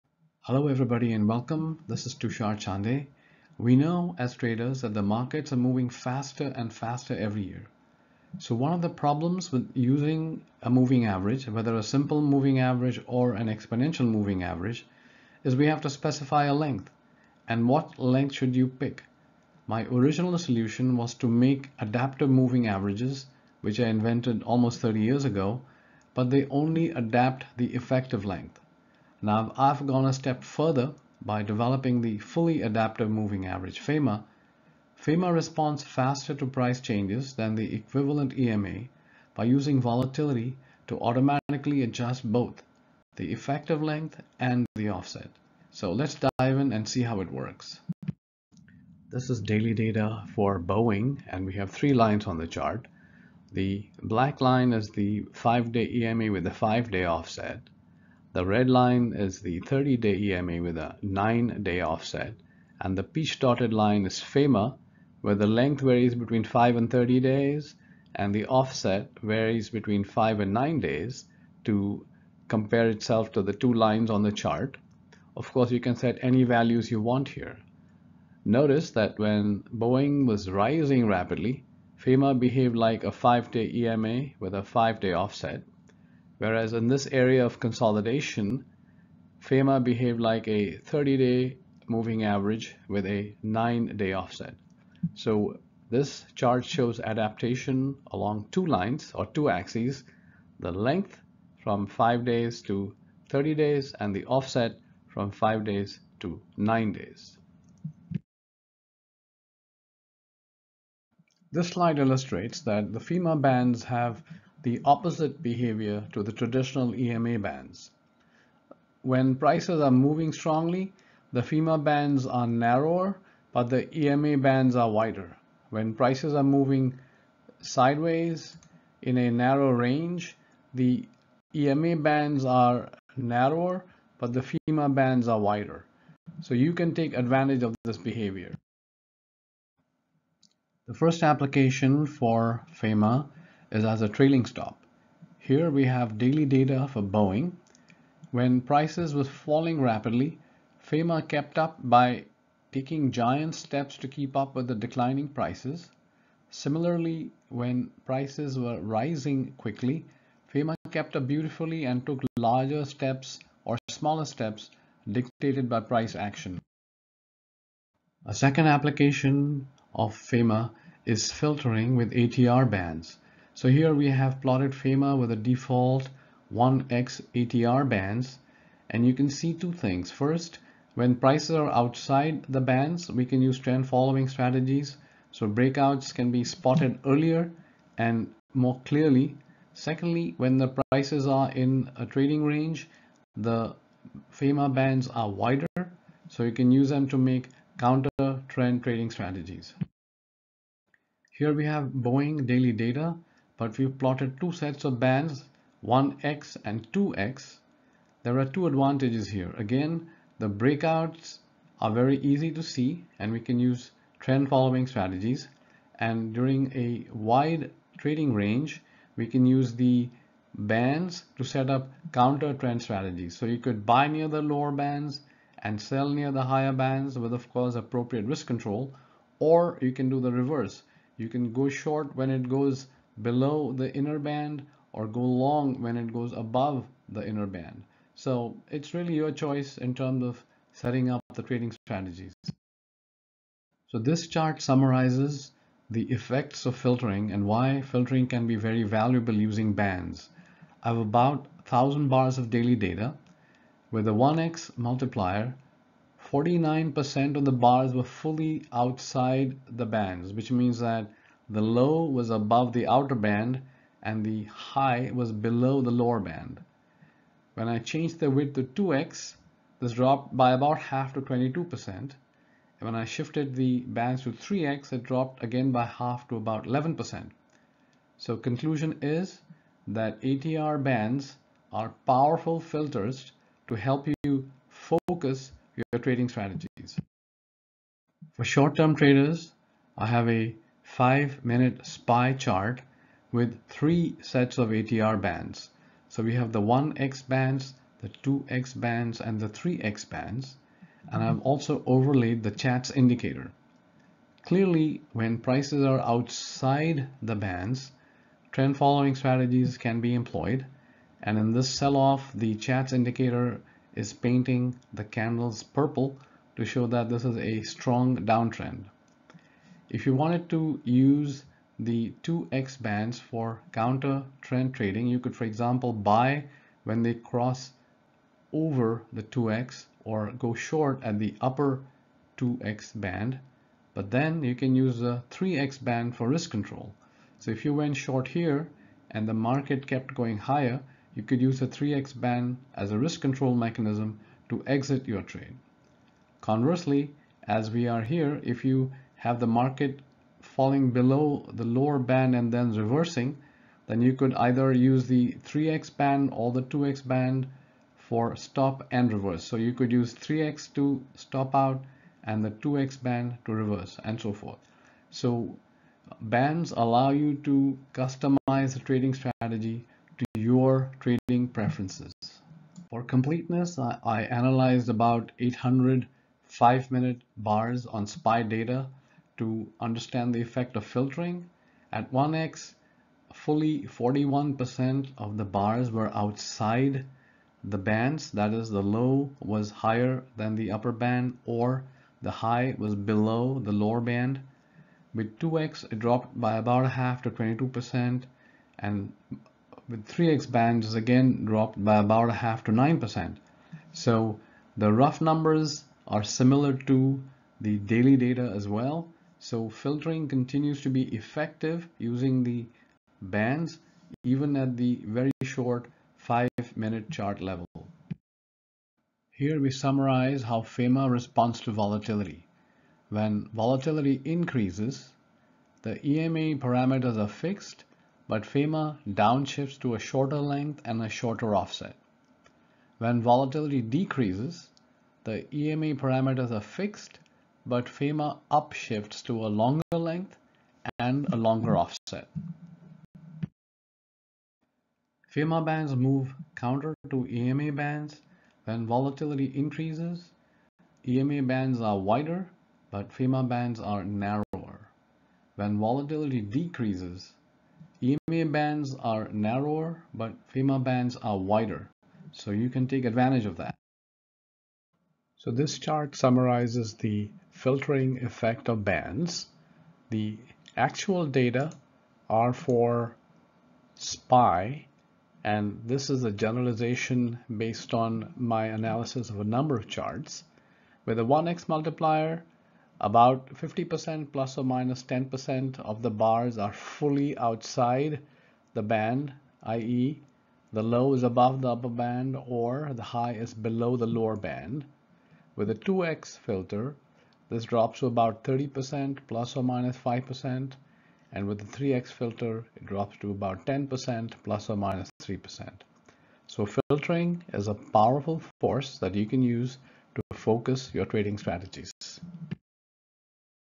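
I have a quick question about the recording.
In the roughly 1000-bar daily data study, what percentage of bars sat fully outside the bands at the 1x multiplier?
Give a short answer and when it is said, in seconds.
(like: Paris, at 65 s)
49%, at 256 s.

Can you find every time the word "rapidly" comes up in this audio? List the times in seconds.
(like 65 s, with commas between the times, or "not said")
81 s, 149 s.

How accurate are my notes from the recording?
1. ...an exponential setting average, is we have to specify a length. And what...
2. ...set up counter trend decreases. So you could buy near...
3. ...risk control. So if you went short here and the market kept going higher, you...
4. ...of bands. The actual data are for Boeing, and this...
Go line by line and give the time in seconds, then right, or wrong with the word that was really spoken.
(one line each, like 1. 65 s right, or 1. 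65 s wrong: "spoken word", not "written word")
1. 13 s wrong: "moving", not "setting"
2. 221 s wrong: "strategies", not "decreases"
3. 336 s right
4. 468 s wrong: "SPY", not "Boeing".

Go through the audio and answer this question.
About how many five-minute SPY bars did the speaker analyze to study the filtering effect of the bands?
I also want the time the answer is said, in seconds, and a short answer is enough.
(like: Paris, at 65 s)
800, at 375 s.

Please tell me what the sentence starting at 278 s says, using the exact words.
So conclusion is that ATR bands are powerful filters to help you focus your trading strategies.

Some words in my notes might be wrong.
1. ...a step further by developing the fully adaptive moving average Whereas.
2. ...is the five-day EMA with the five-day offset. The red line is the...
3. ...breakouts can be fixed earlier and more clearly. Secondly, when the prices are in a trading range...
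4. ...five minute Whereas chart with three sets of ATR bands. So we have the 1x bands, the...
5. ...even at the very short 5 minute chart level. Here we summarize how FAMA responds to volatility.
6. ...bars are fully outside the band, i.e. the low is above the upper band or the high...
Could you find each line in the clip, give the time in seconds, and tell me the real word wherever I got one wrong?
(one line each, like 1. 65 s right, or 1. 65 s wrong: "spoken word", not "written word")
1. 30 s wrong: "FAMA", not "Whereas"
2. 54 s right
3. 185 s wrong: "spotted", not "fixed"
4. 290 s wrong: "SPY", not "Whereas"
5. 414 s right
6. 486 s right.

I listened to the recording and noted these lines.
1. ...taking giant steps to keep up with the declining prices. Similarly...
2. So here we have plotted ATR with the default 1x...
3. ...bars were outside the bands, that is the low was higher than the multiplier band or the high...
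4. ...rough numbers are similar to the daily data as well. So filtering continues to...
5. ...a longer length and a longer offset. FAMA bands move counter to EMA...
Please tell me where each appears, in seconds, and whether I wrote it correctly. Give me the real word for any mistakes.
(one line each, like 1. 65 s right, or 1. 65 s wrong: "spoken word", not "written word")
1. 152 s right
2. 173 s wrong: "FAMA", not "ATR"
3. 385 s wrong: "upper", not "multiplier"
4. 404 s right
5. 439 s right.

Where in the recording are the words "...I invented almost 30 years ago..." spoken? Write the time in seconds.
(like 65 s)
23 s.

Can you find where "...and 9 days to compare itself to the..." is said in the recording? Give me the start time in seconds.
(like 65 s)
70 s.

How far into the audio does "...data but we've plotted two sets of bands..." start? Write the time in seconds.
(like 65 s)
202 s.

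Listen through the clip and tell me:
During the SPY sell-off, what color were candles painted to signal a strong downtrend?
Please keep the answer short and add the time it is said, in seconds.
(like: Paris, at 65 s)
purple, at 315 s.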